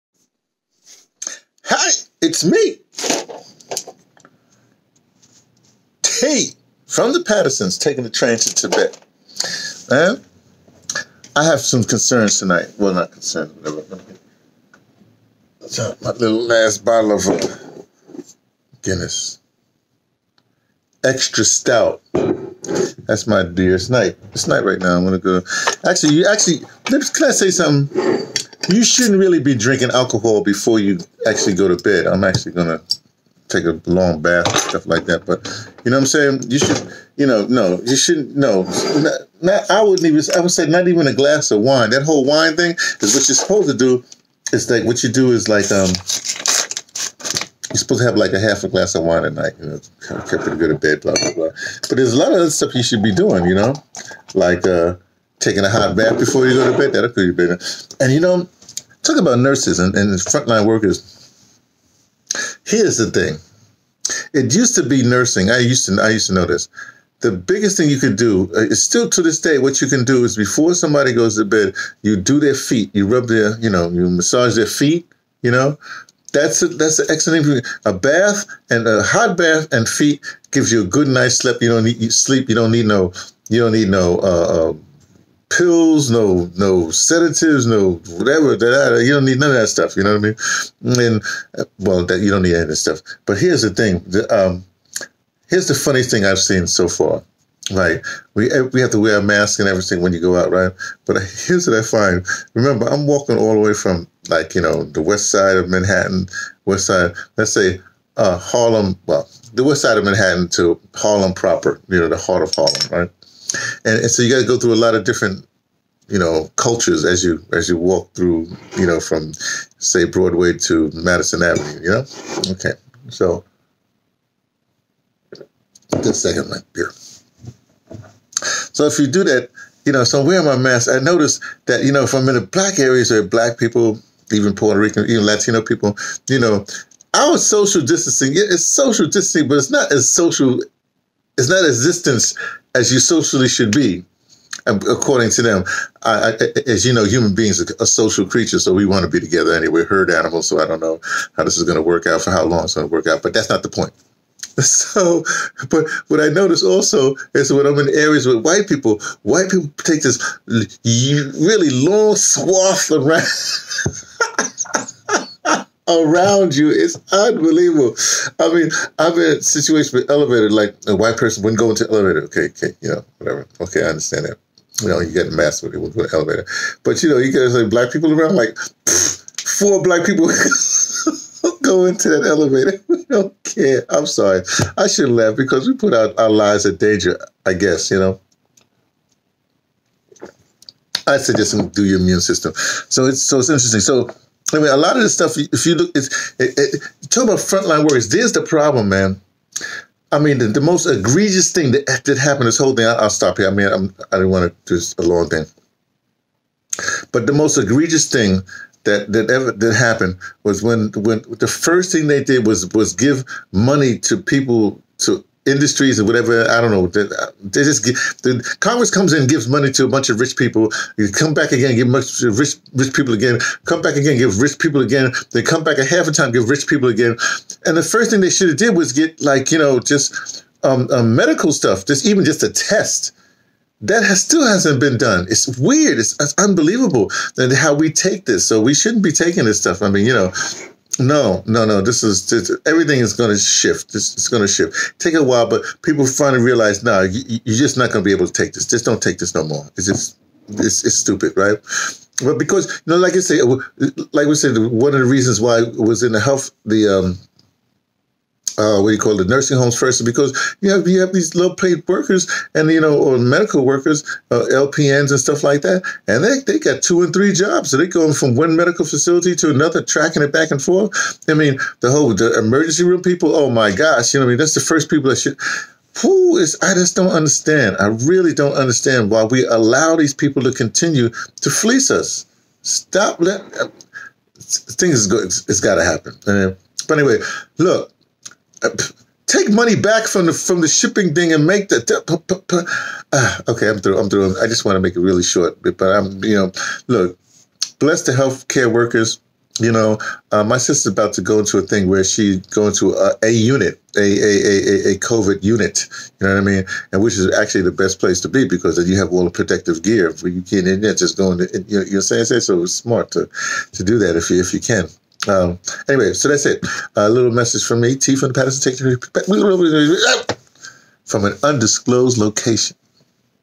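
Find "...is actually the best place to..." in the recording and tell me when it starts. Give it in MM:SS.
05:07.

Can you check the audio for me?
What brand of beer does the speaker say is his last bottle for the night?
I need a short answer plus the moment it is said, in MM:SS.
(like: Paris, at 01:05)
Guinness, at 00:18.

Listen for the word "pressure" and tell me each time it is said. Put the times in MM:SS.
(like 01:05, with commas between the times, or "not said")
not said.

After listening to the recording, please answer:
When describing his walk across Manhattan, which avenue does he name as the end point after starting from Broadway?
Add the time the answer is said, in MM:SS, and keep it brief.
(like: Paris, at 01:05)
Madison Avenue, at 02:00.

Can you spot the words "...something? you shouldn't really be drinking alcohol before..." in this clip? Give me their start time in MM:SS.
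00:27.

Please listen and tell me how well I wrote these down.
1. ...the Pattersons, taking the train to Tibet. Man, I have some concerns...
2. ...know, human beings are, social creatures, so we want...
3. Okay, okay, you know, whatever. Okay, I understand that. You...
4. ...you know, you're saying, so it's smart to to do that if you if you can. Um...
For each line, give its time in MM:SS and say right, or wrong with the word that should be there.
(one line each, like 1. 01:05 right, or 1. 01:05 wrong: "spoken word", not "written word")
1. 00:07 right
2. 02:26 right
3. 02:52 right
4. 05:11 right.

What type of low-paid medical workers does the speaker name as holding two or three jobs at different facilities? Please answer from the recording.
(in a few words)
LPNs.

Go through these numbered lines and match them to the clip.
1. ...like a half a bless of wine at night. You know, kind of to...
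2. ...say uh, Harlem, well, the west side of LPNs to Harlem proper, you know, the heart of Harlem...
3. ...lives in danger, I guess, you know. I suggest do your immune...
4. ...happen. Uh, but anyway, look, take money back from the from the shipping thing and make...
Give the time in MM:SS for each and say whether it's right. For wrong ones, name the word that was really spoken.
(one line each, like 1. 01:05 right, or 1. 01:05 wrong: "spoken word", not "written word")
1. 00:48 wrong: "glass", not "bless"
2. 01:47 wrong: "Manhattan", not "LPNs"
3. 03:06 right
4. 04:45 right.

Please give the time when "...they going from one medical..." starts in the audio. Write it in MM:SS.
04:27.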